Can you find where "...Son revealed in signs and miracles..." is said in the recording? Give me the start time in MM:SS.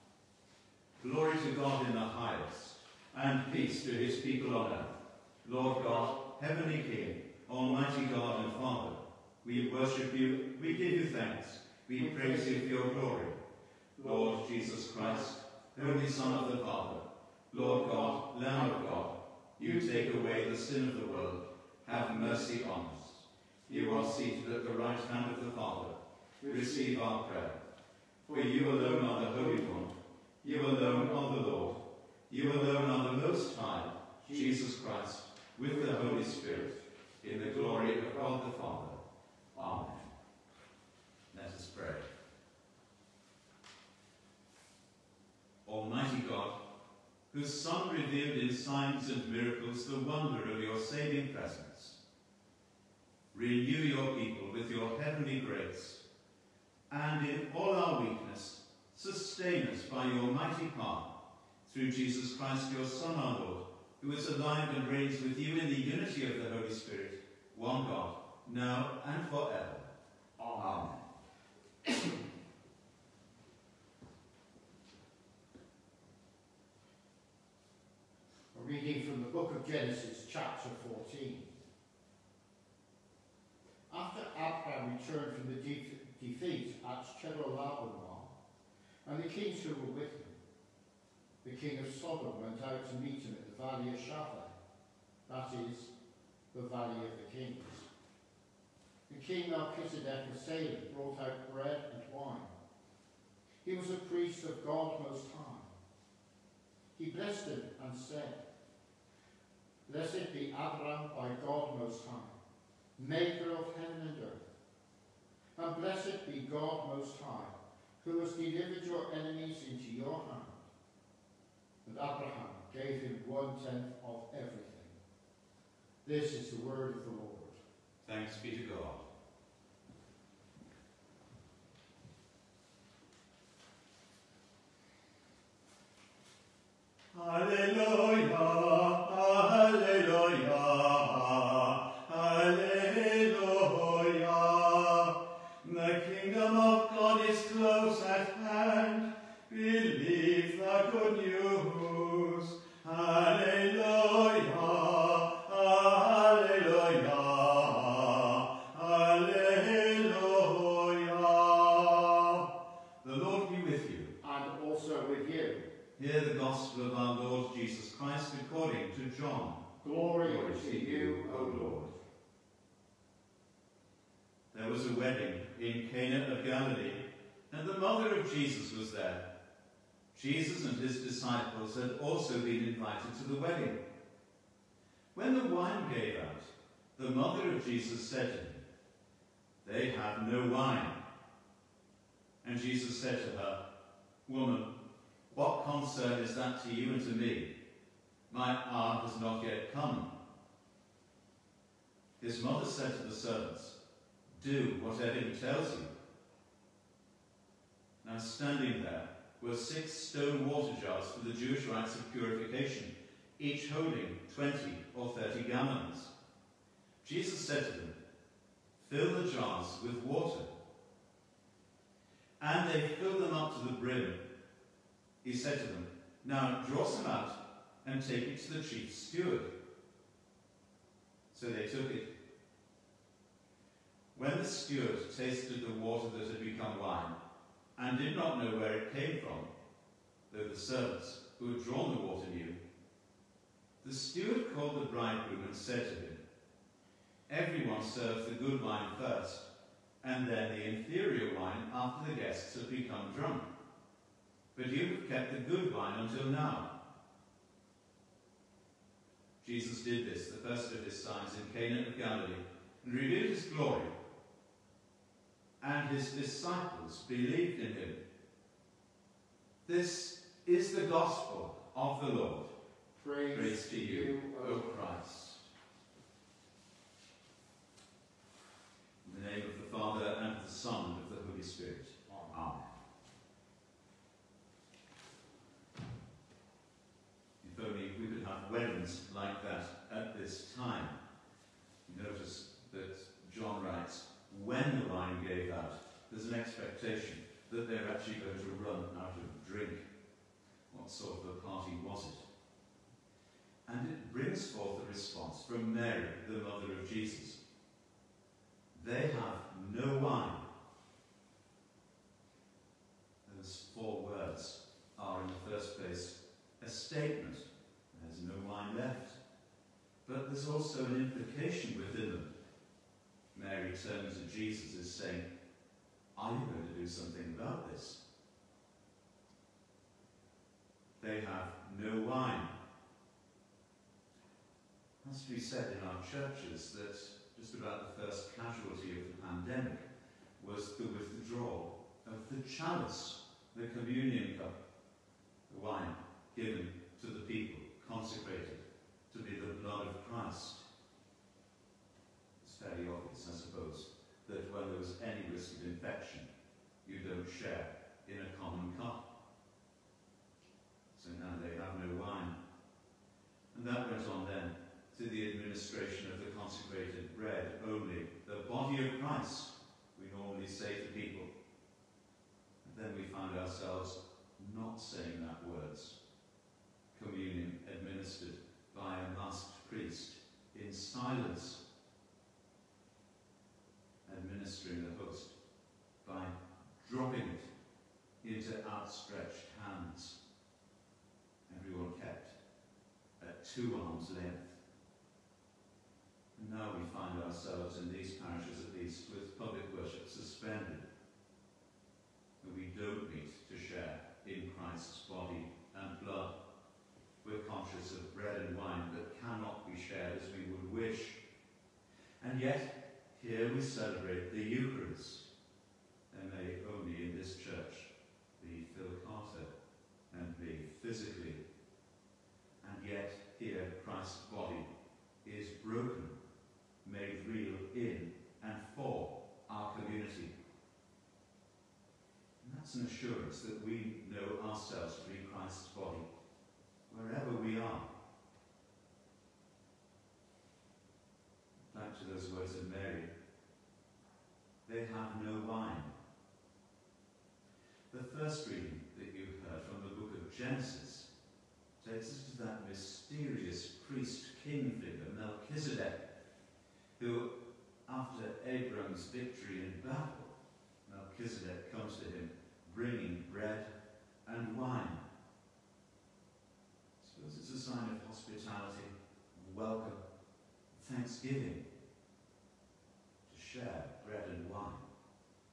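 00:47.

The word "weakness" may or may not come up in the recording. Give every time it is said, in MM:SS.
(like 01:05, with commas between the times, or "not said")
00:58.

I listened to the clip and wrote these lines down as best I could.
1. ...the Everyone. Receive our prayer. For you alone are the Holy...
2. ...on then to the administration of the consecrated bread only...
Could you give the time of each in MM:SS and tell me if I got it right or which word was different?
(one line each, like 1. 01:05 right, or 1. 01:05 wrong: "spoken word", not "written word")
1. 00:25 wrong: "Father", not "Everyone"
2. 06:04 right.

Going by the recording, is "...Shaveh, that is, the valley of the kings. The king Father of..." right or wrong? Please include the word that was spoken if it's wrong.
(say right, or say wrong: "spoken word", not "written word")
wrong: "Melchizedek", not "Father".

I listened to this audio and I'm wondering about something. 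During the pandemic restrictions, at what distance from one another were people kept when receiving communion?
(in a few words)
two arms' length.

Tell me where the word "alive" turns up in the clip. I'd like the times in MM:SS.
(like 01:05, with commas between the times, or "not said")
01:04.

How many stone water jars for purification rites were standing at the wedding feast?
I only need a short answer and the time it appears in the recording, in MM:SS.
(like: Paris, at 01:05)
6, at 03:29.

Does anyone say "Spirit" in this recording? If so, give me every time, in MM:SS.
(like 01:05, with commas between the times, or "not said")
00:36, 01:06.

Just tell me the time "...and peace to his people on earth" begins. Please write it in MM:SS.
00:03.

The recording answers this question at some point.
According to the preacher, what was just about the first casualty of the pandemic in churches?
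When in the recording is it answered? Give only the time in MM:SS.
05:40.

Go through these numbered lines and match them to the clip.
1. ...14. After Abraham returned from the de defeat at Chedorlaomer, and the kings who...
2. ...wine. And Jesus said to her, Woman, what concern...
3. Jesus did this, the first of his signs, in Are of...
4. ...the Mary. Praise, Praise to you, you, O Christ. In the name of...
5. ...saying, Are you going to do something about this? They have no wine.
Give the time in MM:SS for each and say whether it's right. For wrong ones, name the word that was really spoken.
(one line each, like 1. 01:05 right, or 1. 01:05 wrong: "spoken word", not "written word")
1. 01:20 right
2. 03:10 right
3. 04:19 wrong: "Cana", not "Are"
4. 04:32 wrong: "Lord", not "Mary"
5. 05:24 right.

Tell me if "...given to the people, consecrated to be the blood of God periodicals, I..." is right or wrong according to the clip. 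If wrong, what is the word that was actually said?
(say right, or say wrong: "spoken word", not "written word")
wrong: "Christ", not "God".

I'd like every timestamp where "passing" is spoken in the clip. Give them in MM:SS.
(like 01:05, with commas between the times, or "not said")
not said.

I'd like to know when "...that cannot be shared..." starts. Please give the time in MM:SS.
06:48.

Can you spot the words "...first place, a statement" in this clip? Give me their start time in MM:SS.
05:15.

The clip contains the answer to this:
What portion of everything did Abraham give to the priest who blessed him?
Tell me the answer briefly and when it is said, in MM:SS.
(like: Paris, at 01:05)
one tenth, at 02:03.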